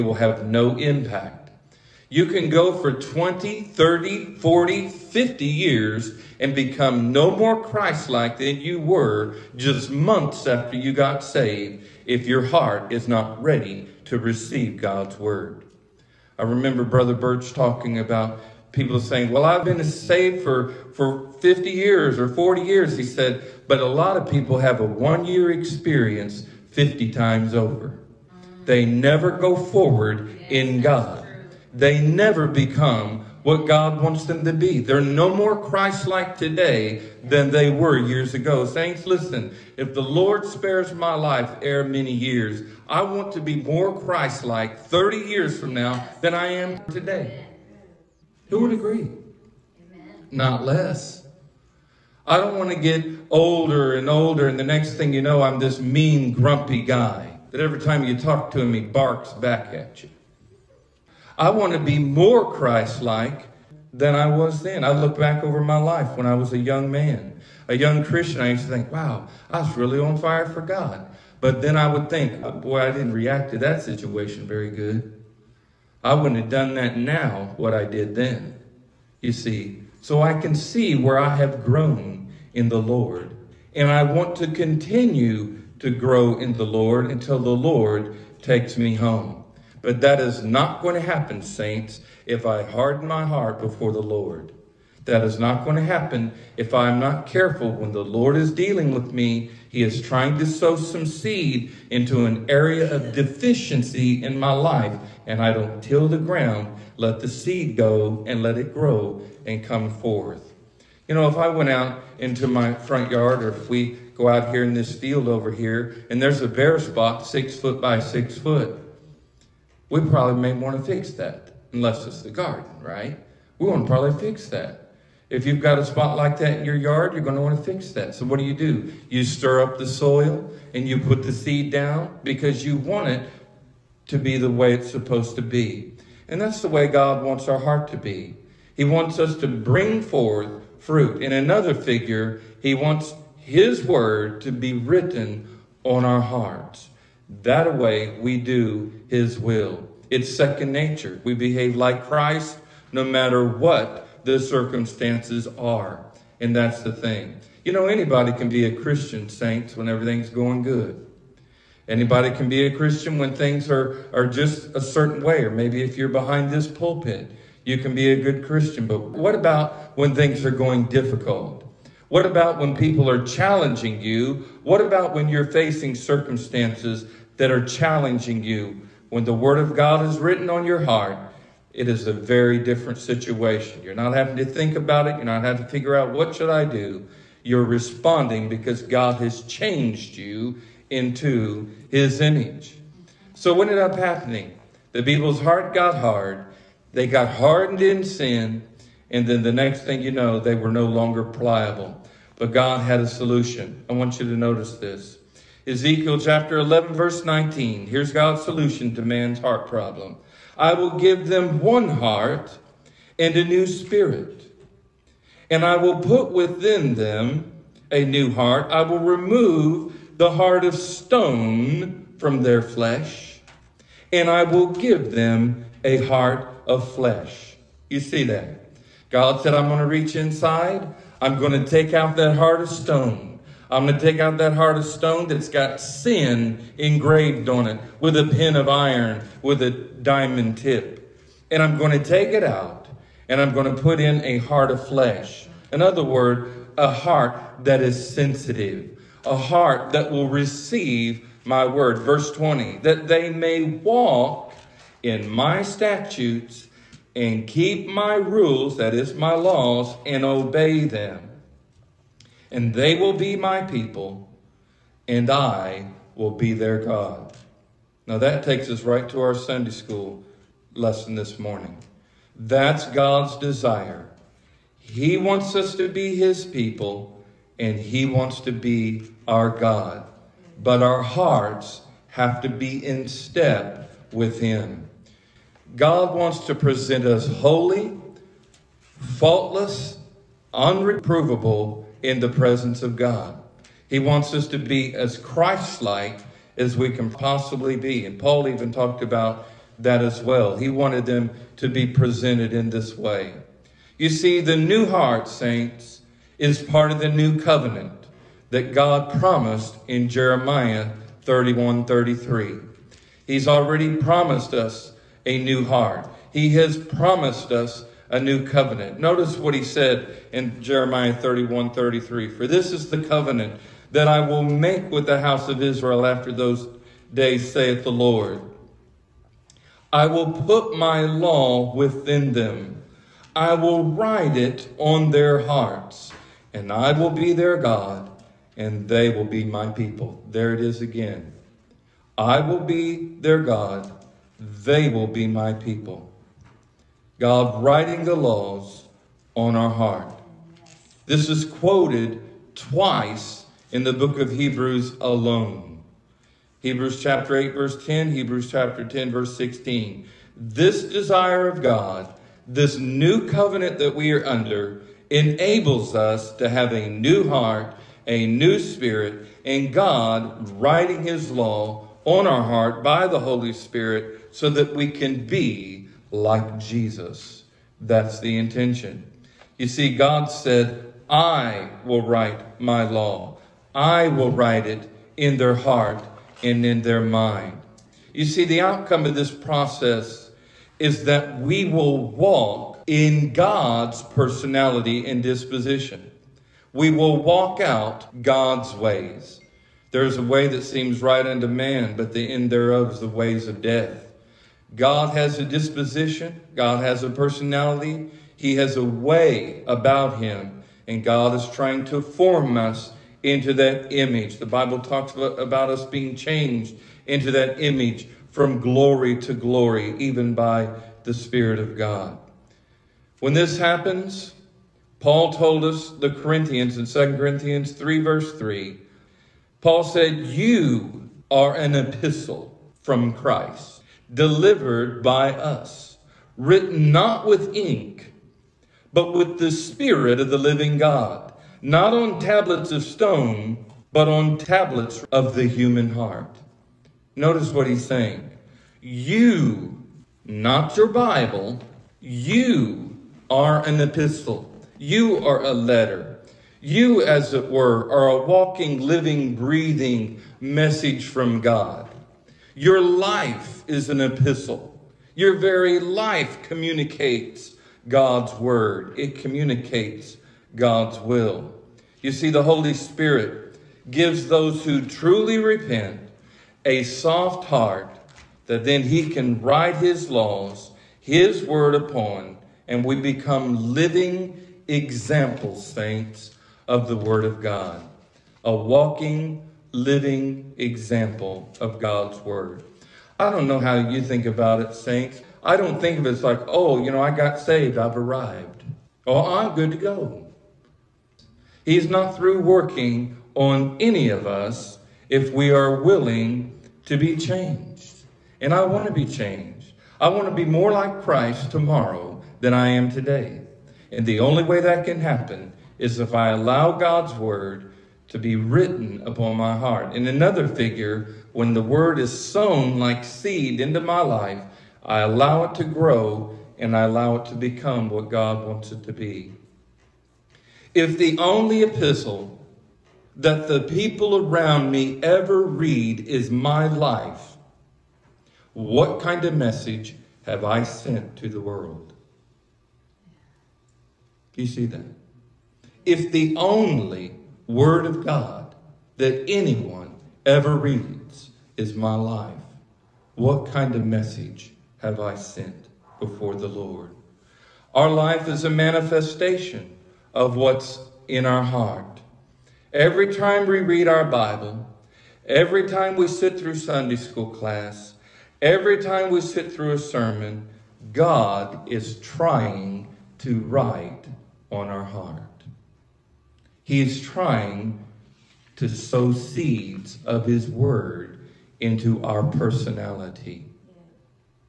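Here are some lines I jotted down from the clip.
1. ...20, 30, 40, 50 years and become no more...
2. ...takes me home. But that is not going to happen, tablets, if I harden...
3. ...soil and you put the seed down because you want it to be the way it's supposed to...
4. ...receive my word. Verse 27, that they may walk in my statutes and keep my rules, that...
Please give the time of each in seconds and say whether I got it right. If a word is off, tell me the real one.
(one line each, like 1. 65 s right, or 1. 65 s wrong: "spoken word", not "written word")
1. 2 s right
2. 88 s wrong: "saints", not "tablets"
3. 129 s right
4. 250 s wrong: "20", not "27".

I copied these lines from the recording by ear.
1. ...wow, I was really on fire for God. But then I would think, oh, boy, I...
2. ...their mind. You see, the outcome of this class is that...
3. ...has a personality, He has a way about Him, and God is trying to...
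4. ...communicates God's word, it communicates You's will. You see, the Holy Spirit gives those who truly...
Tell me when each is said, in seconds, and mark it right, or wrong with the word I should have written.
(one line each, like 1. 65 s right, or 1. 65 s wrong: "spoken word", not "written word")
1. 68 s right
2. 386 s wrong: "process", not "class"
3. 406 s right
4. 466 s wrong: "God", not "You".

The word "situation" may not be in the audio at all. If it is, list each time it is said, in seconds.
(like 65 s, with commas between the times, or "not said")
73 s, 182 s.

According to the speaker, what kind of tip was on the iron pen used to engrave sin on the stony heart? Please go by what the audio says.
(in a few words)
Diamond tip.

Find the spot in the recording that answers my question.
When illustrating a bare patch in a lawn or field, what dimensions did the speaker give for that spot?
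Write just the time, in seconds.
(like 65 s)
117 s.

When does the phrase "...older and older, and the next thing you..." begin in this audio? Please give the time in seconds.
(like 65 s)
53 s.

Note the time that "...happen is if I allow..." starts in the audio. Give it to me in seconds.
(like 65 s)
515 s.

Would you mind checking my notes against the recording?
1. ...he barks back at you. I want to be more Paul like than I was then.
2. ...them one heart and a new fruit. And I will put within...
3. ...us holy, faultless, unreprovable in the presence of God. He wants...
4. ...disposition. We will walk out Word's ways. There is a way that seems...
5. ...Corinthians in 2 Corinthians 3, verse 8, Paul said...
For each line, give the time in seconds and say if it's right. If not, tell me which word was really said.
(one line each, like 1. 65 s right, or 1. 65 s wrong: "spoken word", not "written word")
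1. 58 s wrong: "Christ", not "Paul"
2. 211 s wrong: "spirit", not "fruit"
3. 287 s right
4. 395 s wrong: "God", not "Word"
5. 426 s wrong: "3", not "8".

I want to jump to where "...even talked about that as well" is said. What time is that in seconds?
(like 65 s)
298 s.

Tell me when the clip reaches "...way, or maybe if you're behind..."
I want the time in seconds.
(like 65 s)
165 s.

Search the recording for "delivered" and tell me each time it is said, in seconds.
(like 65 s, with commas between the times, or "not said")
434 s.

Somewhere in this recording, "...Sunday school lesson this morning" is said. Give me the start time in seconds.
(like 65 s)
269 s.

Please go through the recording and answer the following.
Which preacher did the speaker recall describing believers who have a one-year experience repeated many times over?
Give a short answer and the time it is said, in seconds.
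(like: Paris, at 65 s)
Brother Birch, at 16 s.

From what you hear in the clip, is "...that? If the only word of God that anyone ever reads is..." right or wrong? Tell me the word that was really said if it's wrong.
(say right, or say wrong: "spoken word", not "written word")
right.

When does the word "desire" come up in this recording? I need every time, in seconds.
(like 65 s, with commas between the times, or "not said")
273 s, 360 s.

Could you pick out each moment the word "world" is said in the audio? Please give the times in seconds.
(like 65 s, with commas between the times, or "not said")
541 s.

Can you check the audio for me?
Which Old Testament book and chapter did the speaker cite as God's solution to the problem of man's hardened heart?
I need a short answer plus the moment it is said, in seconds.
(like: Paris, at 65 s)
Ezekiel 11, at 205 s.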